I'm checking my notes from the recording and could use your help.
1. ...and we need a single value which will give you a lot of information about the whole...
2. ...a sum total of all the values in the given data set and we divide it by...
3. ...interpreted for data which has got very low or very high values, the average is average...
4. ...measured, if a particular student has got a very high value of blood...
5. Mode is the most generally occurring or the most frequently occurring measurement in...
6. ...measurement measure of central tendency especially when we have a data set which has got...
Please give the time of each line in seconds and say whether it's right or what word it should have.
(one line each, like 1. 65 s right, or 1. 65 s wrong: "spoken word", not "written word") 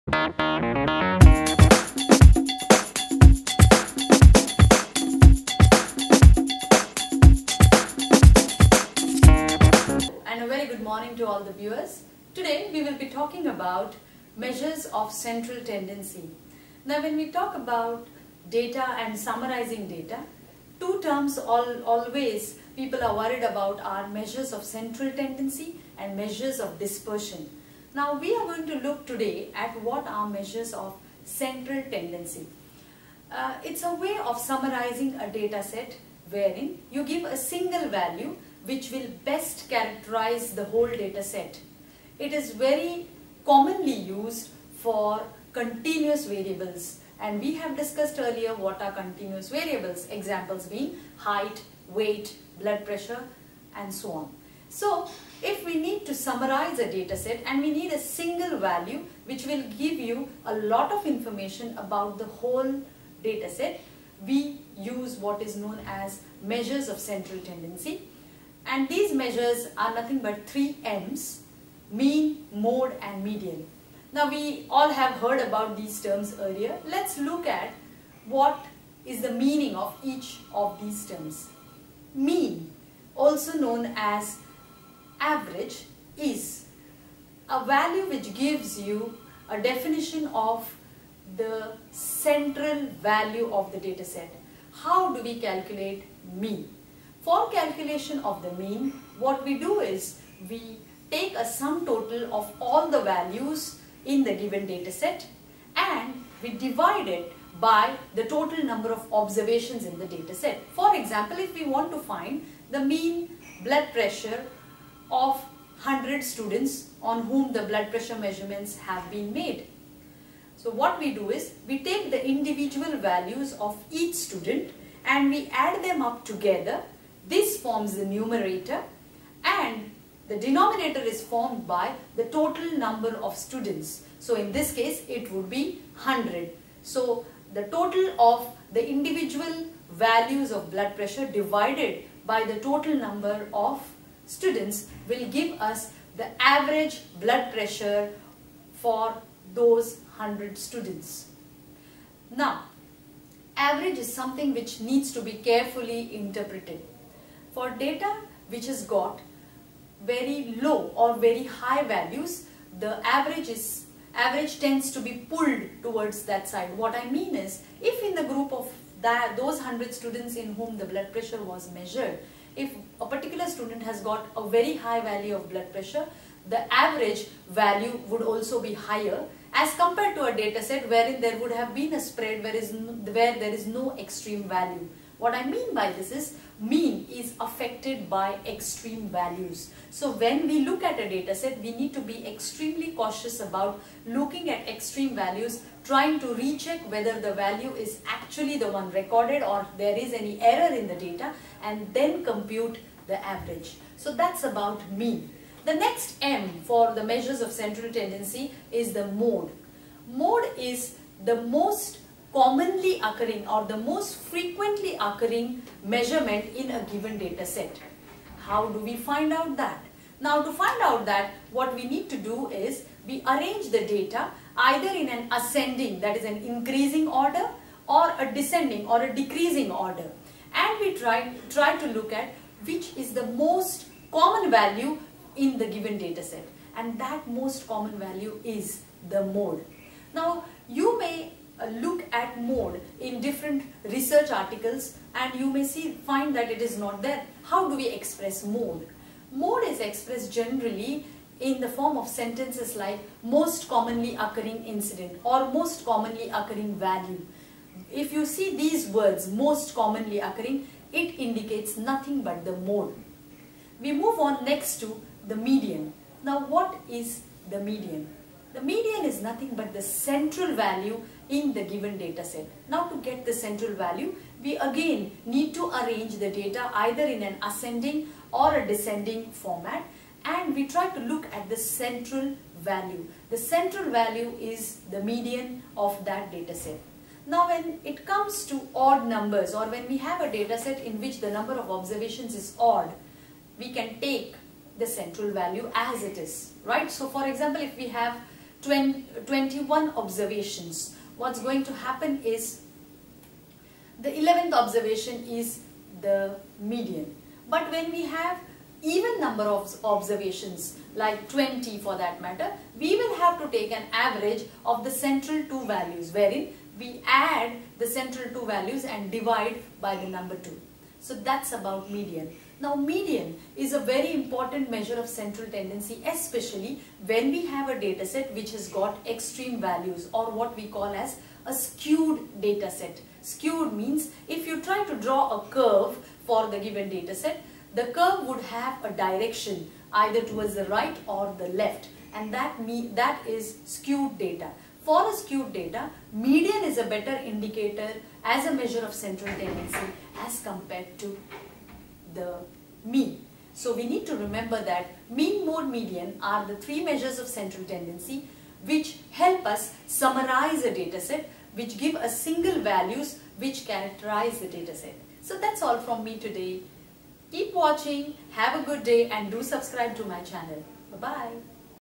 1. 57 s right
2. 101 s right
3. 156 s right
4. 171 s right
5. 210 s wrong: "commonly", not "generally"
6. 324 s wrong: "important", not "measurement".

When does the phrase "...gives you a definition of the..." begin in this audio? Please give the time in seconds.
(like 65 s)
88 s.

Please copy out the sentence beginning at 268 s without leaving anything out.
The median is nothing but the central value in the given data set.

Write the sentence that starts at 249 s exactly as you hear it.
Mode is expressed generally in the form of sentences like most commonly occurring incident or most commonly occurring value.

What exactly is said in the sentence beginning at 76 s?
Let's look at what is the meaning of each of these terms.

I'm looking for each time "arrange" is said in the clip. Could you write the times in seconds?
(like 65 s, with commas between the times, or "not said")
223 s, 275 s.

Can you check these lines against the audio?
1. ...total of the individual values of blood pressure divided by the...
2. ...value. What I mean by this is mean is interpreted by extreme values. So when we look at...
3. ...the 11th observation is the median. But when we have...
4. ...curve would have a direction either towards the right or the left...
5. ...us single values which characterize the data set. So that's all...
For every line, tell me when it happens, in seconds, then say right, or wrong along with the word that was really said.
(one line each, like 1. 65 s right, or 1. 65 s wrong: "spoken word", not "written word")
1. 137 s right
2. 184 s wrong: "affected", not "interpreted"
3. 303 s right
4. 337 s right
5. 361 s right.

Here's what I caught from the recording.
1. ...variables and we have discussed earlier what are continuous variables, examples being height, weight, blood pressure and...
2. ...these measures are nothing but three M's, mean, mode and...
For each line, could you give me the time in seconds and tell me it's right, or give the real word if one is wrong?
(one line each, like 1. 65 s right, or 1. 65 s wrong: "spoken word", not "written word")
1. 46 s right
2. 68 s right.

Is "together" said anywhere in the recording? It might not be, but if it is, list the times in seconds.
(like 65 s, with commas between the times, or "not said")
126 s.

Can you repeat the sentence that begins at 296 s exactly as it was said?
So for example, if we have 21 observations.